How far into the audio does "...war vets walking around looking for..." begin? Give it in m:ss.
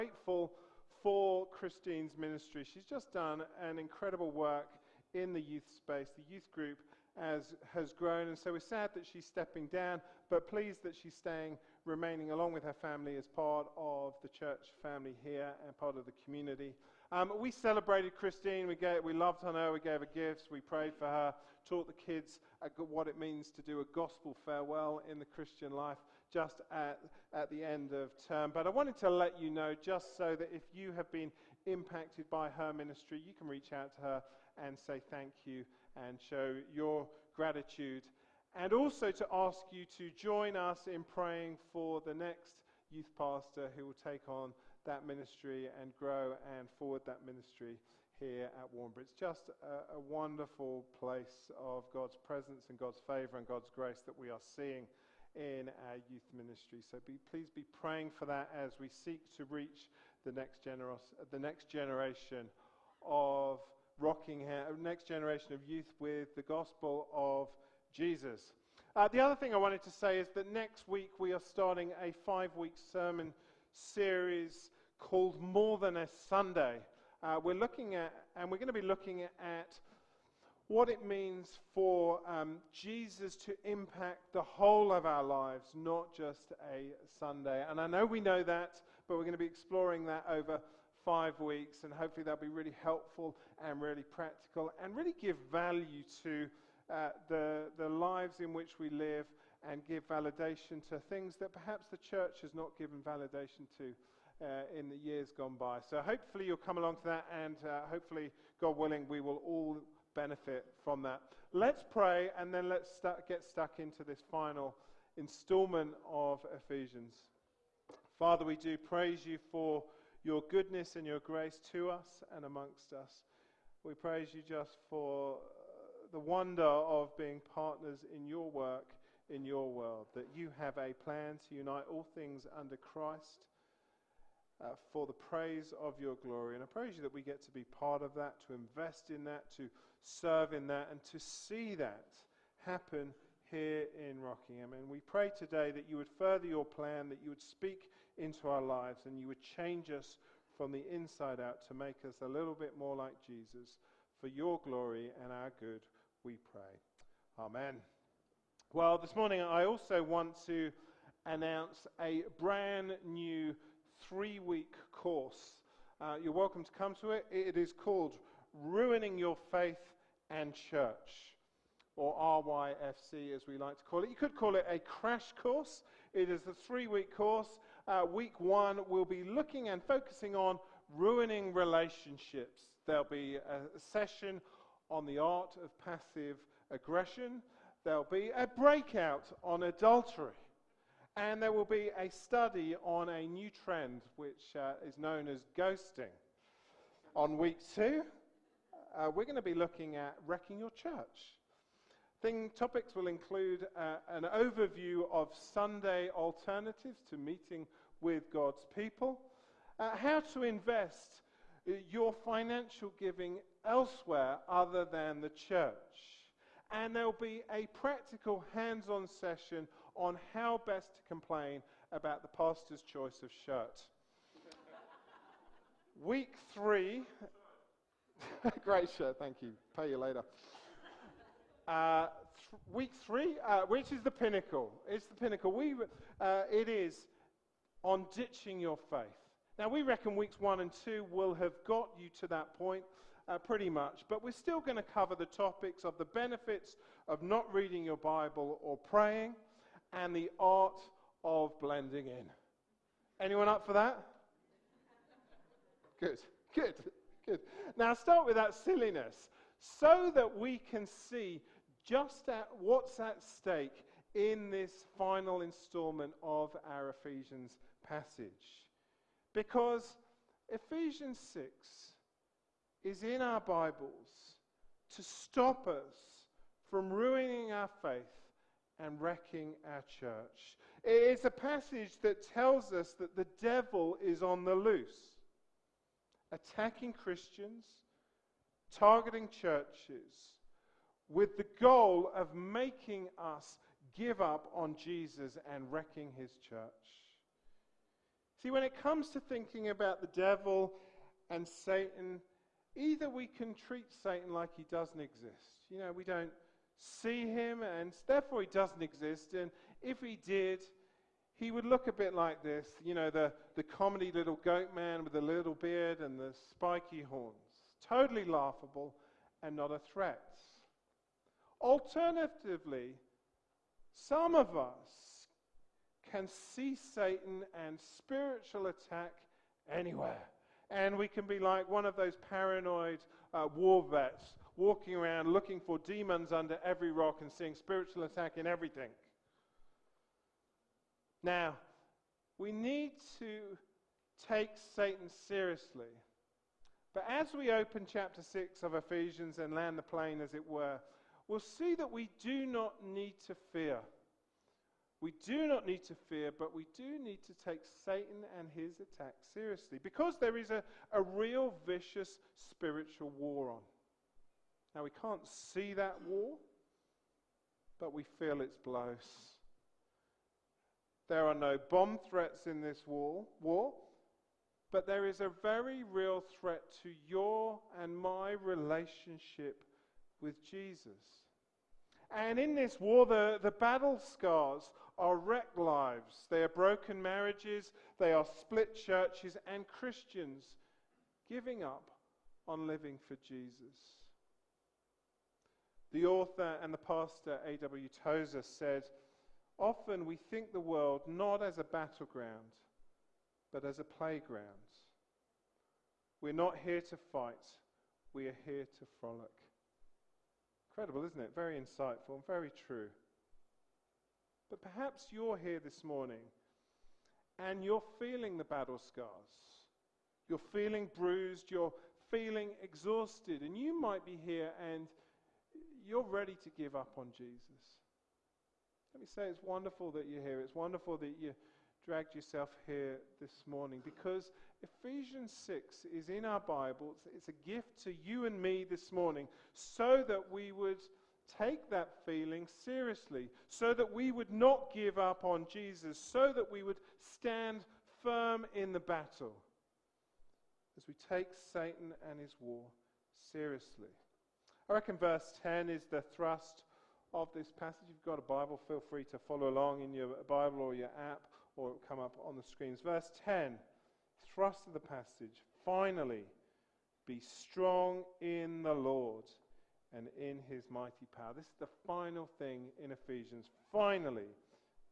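5:33.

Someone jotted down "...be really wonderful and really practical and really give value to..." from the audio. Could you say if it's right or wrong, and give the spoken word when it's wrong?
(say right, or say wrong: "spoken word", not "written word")
wrong: "helpful", not "wonderful".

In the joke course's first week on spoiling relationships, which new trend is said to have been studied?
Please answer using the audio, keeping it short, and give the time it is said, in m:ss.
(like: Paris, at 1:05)
Ghosting, at 3:15.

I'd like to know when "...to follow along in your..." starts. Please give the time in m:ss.
7:39.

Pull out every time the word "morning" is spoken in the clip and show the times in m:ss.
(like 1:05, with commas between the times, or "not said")
2:39, 6:55, 7:13, 7:18.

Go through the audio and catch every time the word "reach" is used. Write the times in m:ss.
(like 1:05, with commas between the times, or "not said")
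0:33, 0:59.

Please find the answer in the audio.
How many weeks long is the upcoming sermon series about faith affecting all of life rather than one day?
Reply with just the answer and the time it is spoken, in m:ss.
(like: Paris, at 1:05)
5, at 1:12.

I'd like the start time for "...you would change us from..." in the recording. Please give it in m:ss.
2:29.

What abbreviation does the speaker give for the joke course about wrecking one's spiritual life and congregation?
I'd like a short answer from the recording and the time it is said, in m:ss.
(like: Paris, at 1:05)
RYFC, at 2:52.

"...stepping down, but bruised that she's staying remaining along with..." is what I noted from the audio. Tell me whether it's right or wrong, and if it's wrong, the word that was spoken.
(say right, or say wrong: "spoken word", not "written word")
wrong: "pleased", not "bruised".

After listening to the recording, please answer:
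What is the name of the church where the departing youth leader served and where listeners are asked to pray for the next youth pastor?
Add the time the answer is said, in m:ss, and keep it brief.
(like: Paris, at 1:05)
Warnbro, at 0:48.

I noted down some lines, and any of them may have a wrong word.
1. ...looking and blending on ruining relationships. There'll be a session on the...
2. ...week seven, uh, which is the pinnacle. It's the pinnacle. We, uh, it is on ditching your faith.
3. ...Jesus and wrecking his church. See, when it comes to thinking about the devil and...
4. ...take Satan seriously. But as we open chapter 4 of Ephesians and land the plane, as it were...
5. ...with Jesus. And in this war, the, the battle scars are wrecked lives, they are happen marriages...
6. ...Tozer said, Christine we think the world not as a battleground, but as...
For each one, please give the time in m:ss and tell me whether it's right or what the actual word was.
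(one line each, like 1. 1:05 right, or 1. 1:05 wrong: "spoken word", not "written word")
1. 2:59 wrong: "focusing", not "blending"
2. 3:52 wrong: "three", not "seven"
3. 4:54 right
4. 5:44 wrong: "6", not "4"
5. 6:20 wrong: "broken", not "happen"
6. 6:38 wrong: "Often", not "Christine".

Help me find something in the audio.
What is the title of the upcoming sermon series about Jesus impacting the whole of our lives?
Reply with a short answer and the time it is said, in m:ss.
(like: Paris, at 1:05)
More Than a Sunday, at 1:15.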